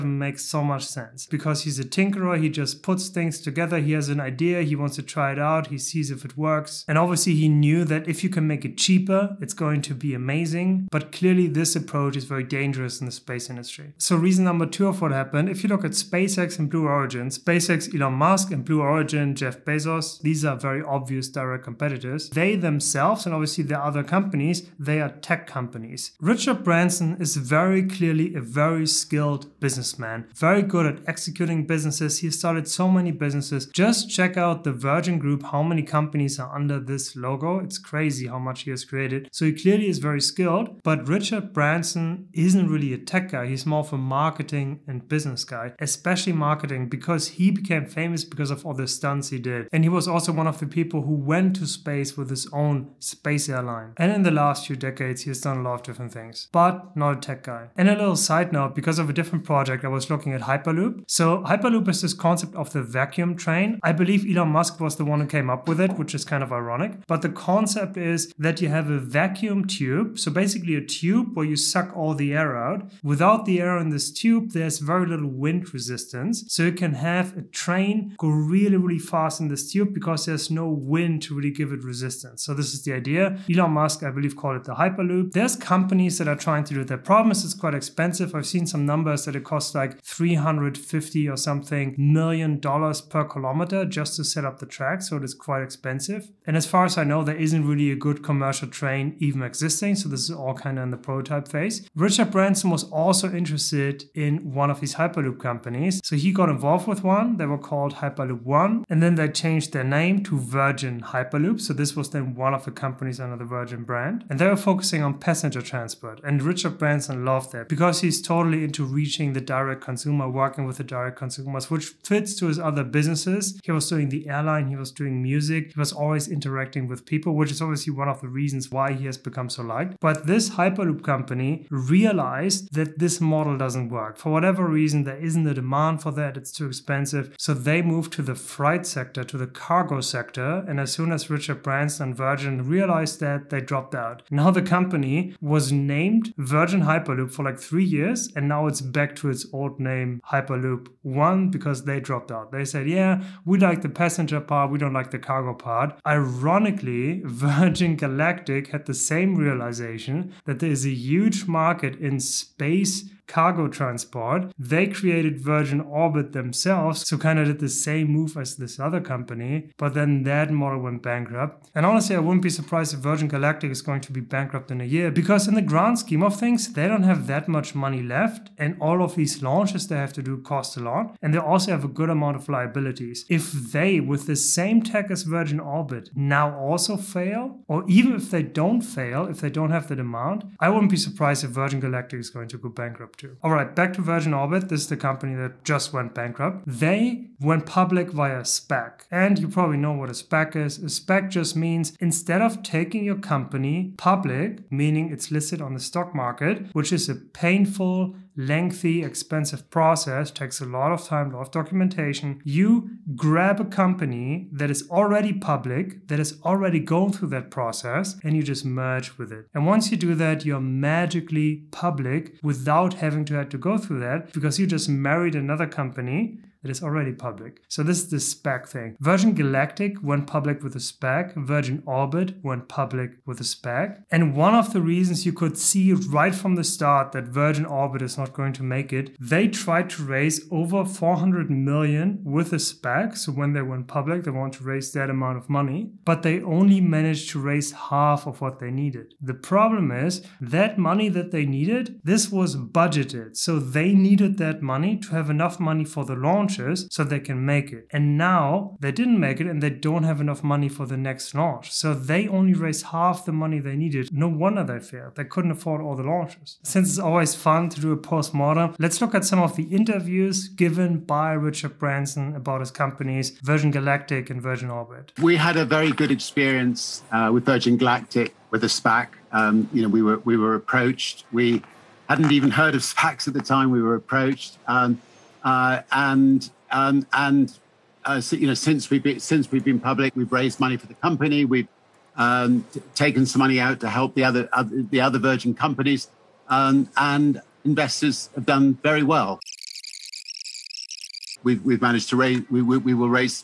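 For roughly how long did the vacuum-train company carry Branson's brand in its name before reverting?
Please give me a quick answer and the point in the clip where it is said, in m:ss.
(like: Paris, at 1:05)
3 years, at 2:27.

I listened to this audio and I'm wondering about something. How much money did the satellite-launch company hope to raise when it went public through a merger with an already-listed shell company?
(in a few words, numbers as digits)
Over 400 million.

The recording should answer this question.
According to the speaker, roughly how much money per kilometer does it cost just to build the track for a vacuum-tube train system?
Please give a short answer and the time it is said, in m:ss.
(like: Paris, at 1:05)
350 million dollars, at 1:30.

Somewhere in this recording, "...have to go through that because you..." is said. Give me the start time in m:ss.
3:43.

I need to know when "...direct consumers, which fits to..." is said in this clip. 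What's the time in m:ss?
2:00.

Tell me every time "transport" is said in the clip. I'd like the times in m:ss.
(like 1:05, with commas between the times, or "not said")
1:55, 2:43.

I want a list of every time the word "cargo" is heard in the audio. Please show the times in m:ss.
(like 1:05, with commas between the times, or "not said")
2:19, 2:35, 2:43.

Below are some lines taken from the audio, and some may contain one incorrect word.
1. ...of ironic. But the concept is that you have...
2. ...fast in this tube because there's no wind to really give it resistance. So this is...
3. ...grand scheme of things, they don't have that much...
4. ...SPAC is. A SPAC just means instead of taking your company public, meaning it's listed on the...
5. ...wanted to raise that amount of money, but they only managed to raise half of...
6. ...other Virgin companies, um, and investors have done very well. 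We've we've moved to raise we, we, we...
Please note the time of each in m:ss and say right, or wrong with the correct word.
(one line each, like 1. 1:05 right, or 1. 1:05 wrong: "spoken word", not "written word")
1. 1:06 right
2. 1:18 right
3. 2:55 right
4. 3:20 right
5. 4:04 right
6. 4:54 wrong: "managed", not "moved".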